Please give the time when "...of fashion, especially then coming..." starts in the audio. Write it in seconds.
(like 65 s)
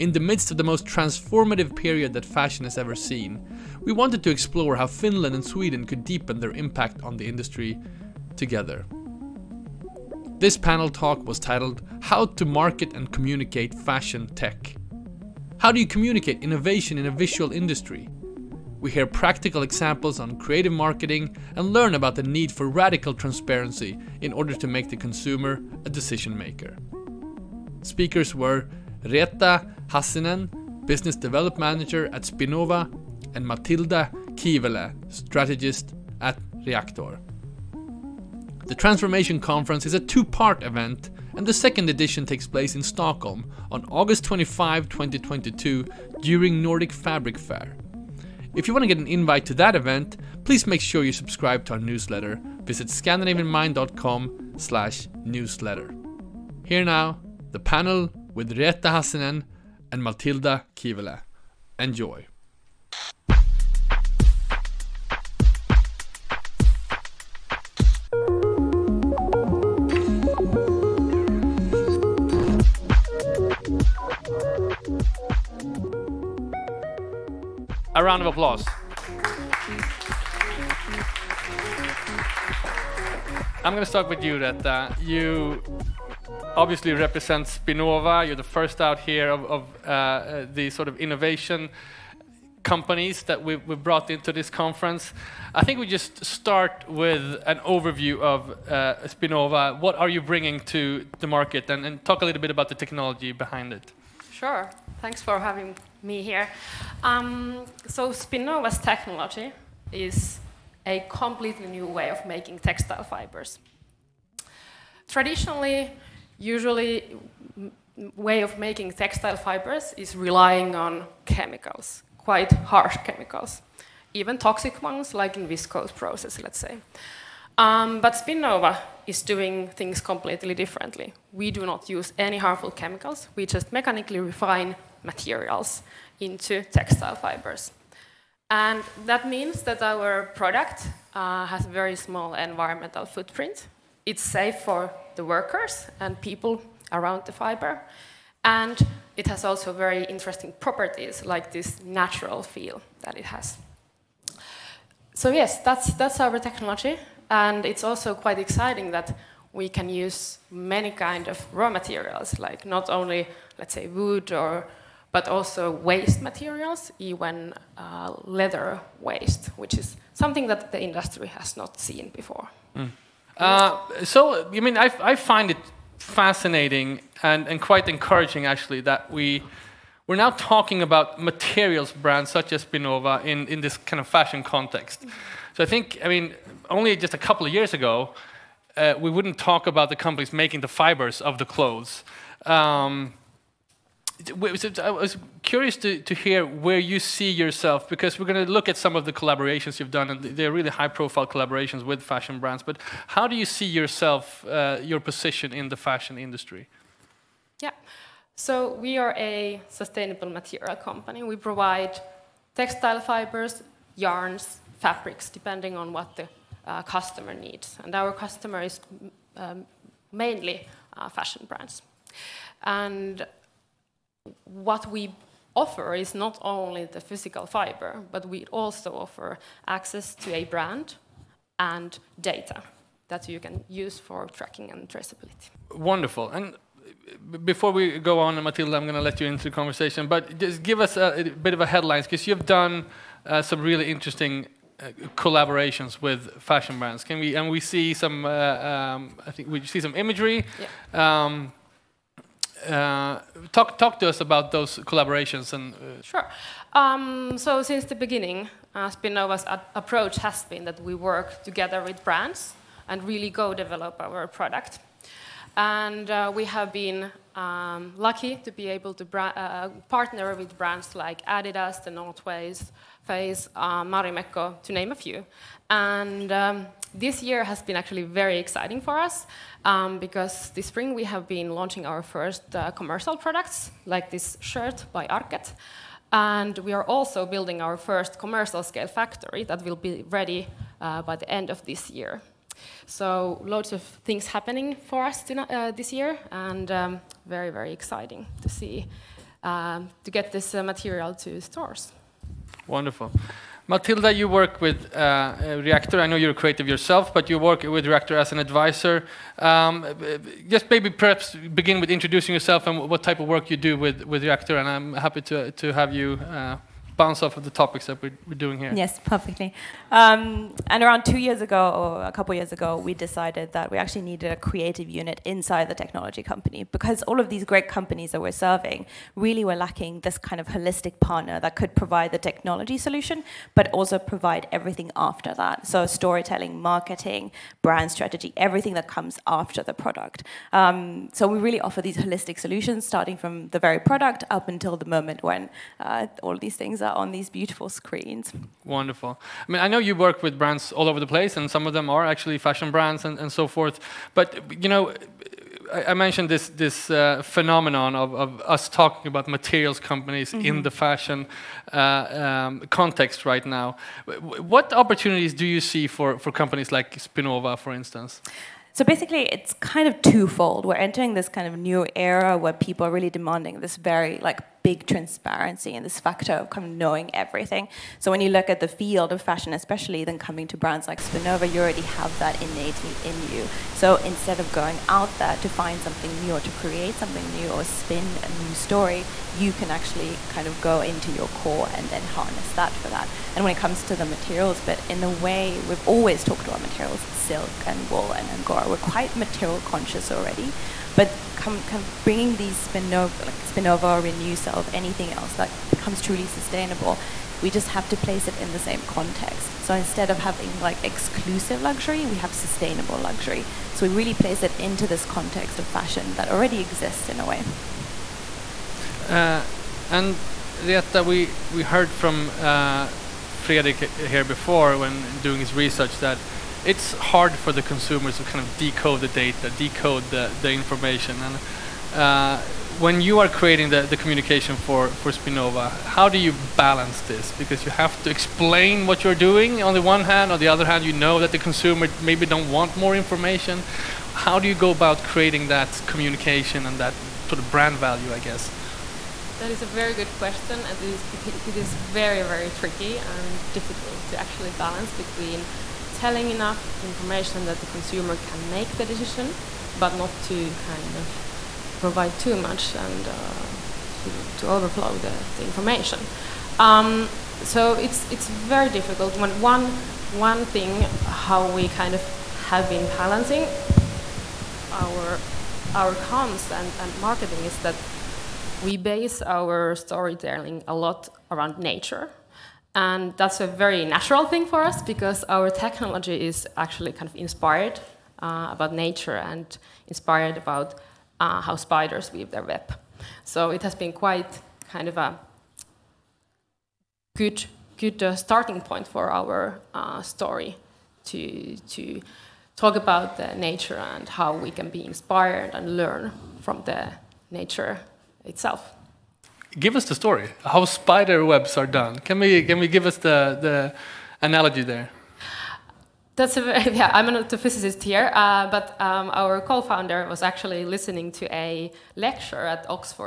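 379 s.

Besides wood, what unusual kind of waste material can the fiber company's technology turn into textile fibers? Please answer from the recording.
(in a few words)
leather waste.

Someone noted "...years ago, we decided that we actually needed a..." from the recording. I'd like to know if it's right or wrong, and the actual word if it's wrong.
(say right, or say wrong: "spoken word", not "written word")
right.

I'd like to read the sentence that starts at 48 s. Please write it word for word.
If you want to get an invite to that event, please make sure you subscribe to our newsletter.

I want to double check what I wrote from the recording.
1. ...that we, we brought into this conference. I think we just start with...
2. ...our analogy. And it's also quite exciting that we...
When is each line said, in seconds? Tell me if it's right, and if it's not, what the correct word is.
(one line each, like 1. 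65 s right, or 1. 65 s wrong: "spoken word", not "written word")
1. 93 s right
2. 156 s wrong: "technology", not "analogy".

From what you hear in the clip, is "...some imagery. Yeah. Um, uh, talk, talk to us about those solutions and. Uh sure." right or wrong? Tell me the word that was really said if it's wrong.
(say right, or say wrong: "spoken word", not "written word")
wrong: "collaborations", not "solutions".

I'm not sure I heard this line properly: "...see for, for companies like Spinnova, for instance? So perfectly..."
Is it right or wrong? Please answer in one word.
wrong.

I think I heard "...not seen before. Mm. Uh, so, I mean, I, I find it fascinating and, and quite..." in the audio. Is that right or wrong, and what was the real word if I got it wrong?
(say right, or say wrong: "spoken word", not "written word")
right.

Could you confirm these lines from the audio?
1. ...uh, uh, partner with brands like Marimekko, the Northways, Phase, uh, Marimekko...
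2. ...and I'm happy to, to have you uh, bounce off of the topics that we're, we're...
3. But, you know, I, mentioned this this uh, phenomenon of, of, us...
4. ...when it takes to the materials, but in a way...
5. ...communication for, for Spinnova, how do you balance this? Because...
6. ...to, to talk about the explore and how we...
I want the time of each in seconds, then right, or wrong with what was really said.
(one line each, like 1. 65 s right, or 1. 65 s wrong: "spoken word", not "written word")
1. 269 s wrong: "Adidas", not "Marimekko"
2. 314 s right
3. 354 s right
4. 393 s wrong: "comes", not "takes"
5. 433 s right
6. 501 s wrong: "nature", not "explore".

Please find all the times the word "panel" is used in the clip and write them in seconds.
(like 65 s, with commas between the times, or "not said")
10 s, 57 s.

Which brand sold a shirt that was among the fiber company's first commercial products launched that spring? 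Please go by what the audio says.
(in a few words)
Arket.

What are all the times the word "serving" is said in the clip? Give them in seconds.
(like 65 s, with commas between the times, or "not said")
328 s.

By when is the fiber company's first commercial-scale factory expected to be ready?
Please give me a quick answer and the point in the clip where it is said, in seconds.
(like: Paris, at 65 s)
end of this year, at 291 s.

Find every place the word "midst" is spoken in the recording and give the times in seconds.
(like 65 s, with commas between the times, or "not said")
0 s.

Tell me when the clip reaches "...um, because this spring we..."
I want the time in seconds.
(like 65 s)
279 s.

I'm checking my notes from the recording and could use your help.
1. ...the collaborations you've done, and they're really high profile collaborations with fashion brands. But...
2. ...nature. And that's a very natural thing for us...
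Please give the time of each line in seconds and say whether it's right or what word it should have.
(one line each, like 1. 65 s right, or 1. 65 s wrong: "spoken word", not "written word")
1. 199 s right
2. 481 s right.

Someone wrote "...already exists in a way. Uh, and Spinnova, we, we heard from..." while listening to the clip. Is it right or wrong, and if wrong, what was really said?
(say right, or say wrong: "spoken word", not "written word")
wrong: "Reetta", not "Spinnova".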